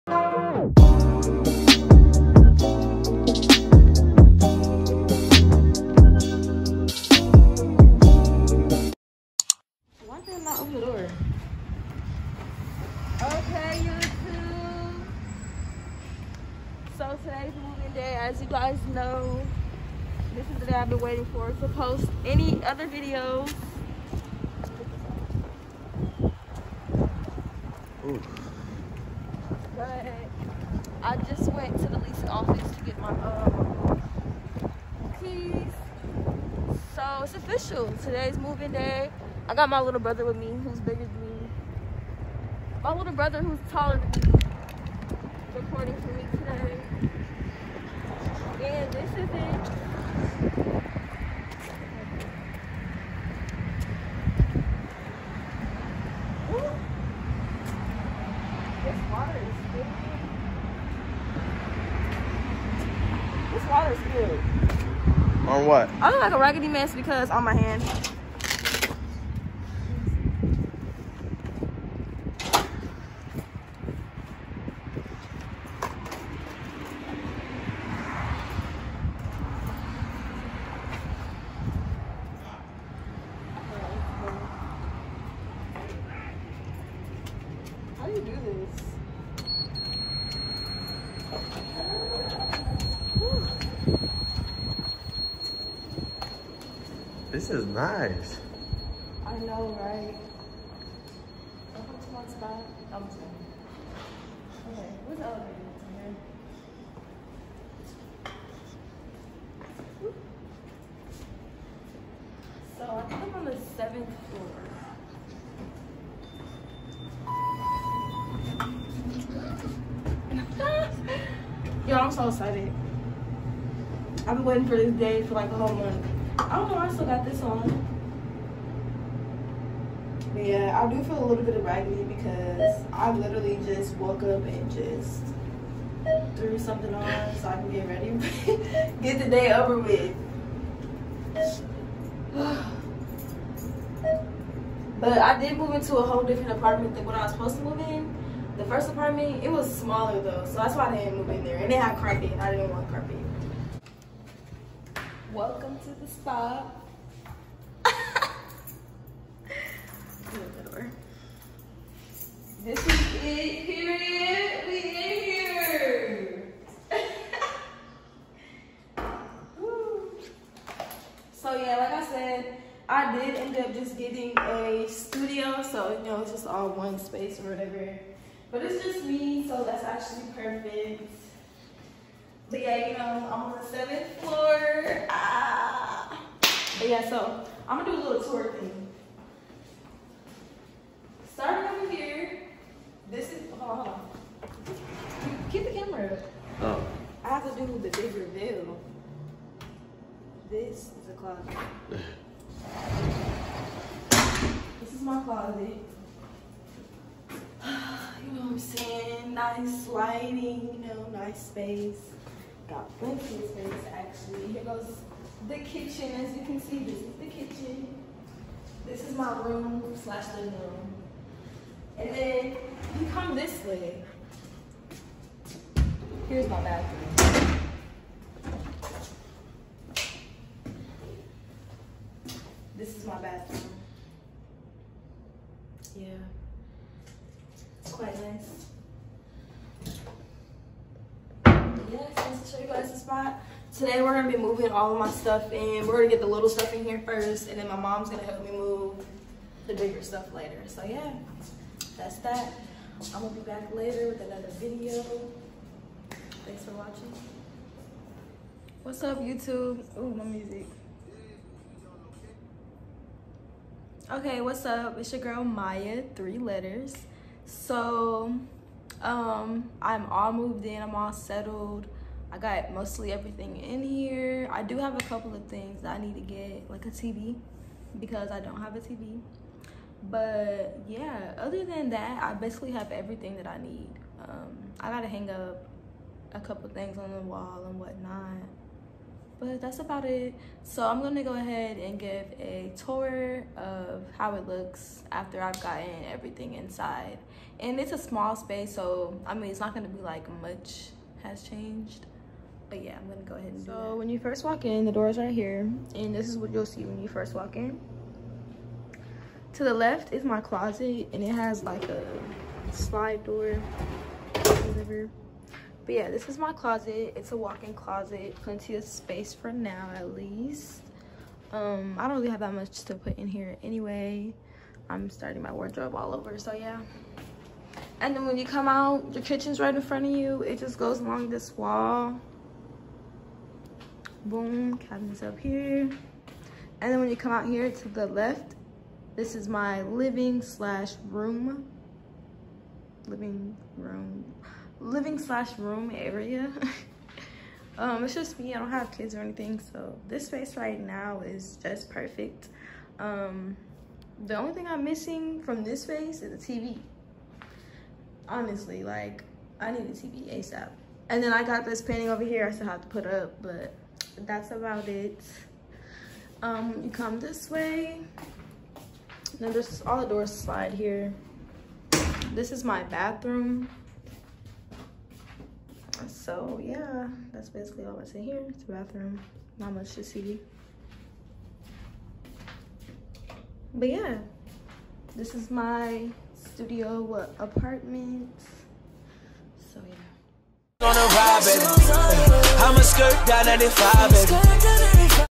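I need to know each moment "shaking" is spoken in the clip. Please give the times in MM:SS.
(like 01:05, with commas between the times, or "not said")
not said.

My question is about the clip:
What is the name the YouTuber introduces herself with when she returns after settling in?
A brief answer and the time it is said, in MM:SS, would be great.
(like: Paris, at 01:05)
Mya, at 04:25.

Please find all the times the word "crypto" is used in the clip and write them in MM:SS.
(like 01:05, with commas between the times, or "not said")
not said.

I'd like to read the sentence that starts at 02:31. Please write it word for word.
And they had carpet, I didn't want carpet.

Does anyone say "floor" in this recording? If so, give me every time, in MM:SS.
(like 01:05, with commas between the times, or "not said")
01:54, 03:04.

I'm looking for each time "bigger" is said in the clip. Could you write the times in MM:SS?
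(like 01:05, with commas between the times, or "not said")
00:40, 04:09.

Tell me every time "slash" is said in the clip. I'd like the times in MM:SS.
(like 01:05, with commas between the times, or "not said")
03:40, 05:40, 05:45.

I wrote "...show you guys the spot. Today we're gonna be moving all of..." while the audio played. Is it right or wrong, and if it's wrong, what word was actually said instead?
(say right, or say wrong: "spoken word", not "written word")
right.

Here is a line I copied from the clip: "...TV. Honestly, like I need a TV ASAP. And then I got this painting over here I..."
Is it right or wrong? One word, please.
right.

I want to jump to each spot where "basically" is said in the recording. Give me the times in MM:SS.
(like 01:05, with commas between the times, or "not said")
04:42, 06:17.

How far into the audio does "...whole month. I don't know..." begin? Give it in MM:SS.
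02:05.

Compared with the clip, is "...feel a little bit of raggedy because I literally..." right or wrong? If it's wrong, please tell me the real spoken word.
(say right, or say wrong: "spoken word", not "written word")
right.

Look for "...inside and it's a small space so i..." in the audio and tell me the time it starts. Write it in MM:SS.
04:56.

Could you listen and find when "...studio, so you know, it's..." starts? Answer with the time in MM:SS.
02:54.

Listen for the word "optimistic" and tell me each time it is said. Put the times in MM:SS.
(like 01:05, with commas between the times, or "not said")
not said.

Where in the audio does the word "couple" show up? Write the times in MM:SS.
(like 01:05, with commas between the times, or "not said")
04:35, 04:46.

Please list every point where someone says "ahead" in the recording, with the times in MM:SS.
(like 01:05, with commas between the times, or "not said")
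04:51, 05:03.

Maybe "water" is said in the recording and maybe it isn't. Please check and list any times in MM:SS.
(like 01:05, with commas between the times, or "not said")
00:59, 01:03.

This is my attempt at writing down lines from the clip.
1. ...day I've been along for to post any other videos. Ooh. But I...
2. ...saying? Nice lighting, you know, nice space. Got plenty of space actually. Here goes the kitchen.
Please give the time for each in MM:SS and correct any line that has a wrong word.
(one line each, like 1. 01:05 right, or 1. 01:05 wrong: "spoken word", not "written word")
1. 00:20 wrong: "waiting", not "along"
2. 03:28 right.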